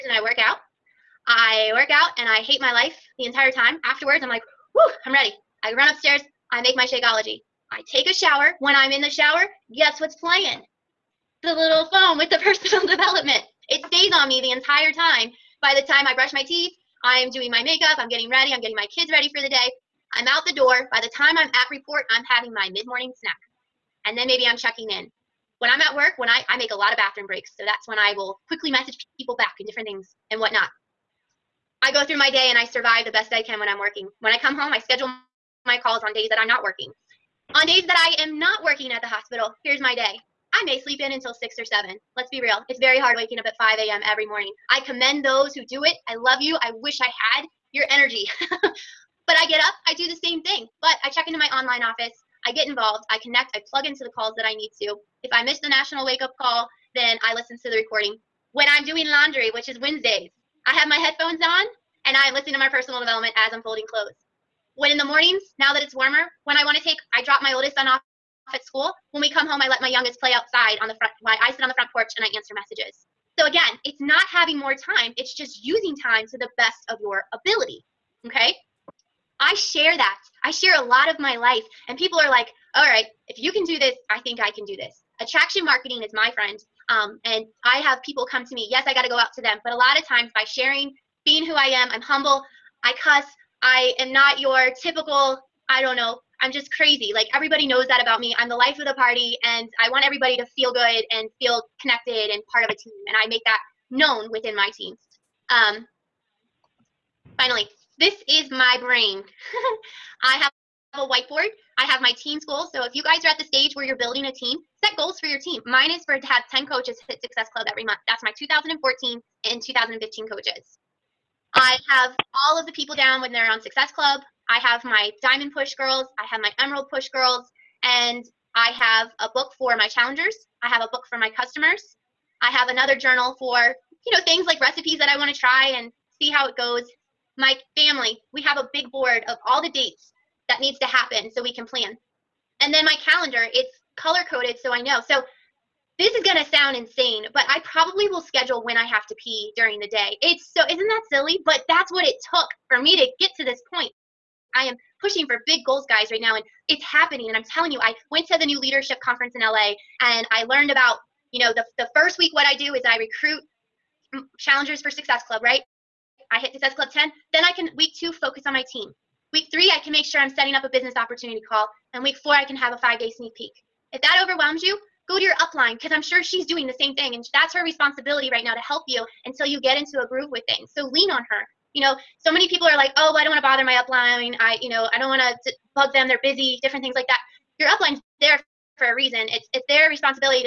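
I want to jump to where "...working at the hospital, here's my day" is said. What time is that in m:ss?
0:38.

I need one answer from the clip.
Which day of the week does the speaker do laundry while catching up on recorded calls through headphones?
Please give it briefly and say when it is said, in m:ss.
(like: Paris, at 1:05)
Wednesdays, at 0:59.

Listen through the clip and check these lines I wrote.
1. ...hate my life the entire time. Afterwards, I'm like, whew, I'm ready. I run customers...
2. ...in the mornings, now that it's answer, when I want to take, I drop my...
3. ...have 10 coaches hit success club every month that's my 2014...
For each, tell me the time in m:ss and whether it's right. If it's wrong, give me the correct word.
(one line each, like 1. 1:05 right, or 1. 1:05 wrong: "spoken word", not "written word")
1. 0:02 wrong: "upstairs", not "customers"
2. 1:04 wrong: "warmer", not "answer"
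3. 1:56 right.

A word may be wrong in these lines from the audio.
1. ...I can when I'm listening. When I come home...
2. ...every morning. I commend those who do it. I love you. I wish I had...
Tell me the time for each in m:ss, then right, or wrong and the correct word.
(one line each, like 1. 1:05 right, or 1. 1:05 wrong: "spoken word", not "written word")
1. 0:33 wrong: "working", not "listening"
2. 0:44 right.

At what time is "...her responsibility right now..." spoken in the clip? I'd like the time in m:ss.
2:57.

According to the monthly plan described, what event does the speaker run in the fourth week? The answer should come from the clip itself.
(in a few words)
five day sneak peek.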